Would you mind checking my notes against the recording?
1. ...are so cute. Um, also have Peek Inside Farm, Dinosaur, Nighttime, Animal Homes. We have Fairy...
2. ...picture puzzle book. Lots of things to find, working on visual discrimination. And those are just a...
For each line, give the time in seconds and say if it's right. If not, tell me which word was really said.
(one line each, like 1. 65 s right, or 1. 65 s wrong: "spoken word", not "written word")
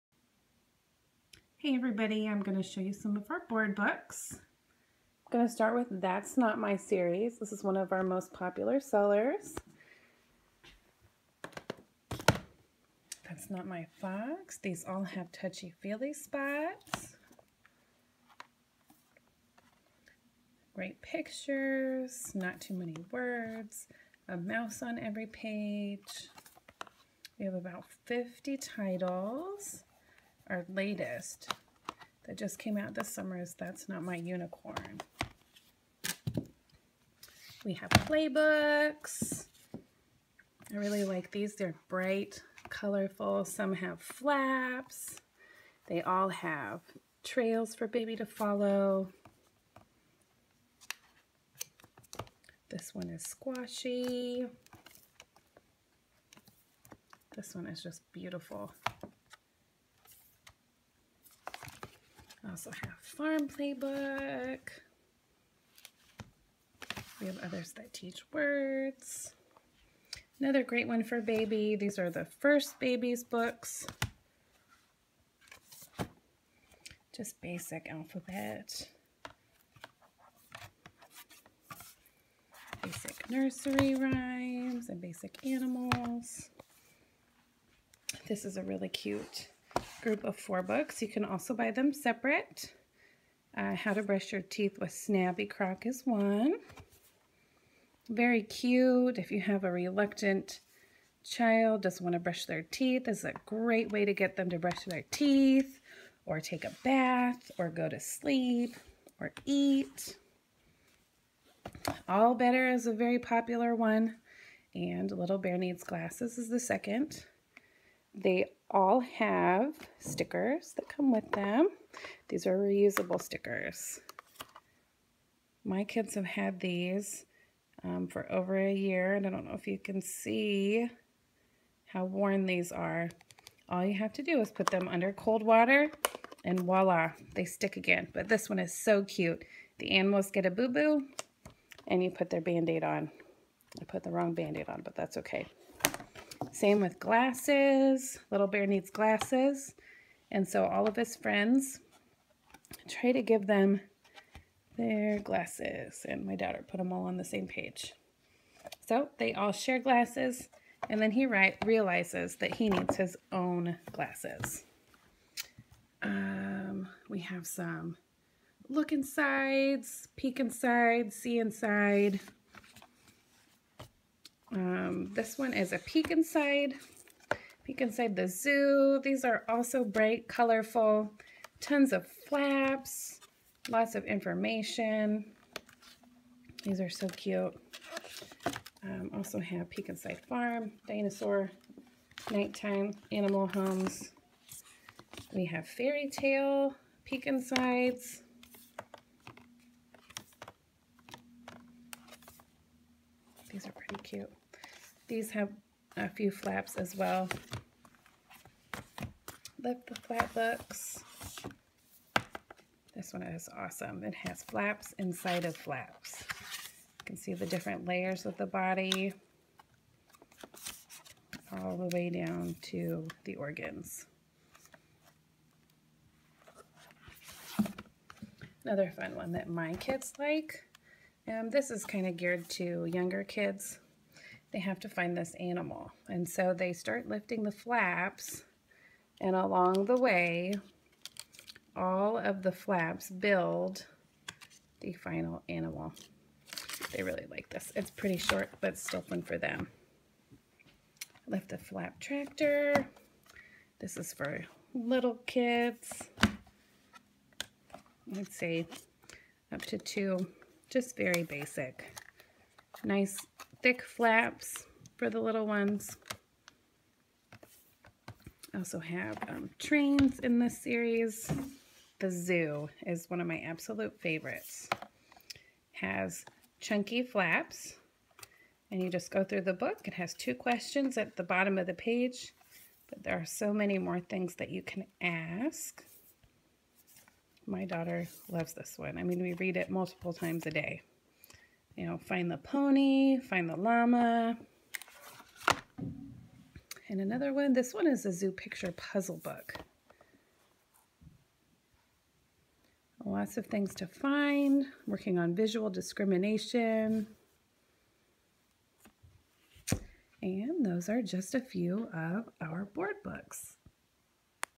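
1. 186 s right
2. 298 s right.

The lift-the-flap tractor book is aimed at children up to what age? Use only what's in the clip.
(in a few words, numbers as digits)
2.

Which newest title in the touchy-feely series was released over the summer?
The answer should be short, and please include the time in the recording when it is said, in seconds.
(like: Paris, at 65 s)
That's Not My Unicorn, at 33 s.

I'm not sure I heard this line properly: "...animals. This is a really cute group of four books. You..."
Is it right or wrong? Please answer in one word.
right.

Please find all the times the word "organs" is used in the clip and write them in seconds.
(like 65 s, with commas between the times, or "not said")
223 s.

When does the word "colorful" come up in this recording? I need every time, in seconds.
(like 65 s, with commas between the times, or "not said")
42 s, 180 s.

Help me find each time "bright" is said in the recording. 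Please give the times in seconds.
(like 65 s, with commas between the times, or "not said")
41 s, 179 s.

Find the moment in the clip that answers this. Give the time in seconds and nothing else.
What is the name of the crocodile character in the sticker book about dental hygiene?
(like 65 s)
94 s.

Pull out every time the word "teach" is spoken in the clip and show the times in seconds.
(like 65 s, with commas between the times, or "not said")
67 s.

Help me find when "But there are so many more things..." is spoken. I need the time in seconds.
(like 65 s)
282 s.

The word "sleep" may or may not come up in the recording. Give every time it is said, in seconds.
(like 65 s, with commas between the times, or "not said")
107 s.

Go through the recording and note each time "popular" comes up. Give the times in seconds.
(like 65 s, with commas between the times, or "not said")
8 s, 113 s.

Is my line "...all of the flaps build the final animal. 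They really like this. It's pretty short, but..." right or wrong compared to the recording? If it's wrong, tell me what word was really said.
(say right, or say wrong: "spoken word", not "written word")
right.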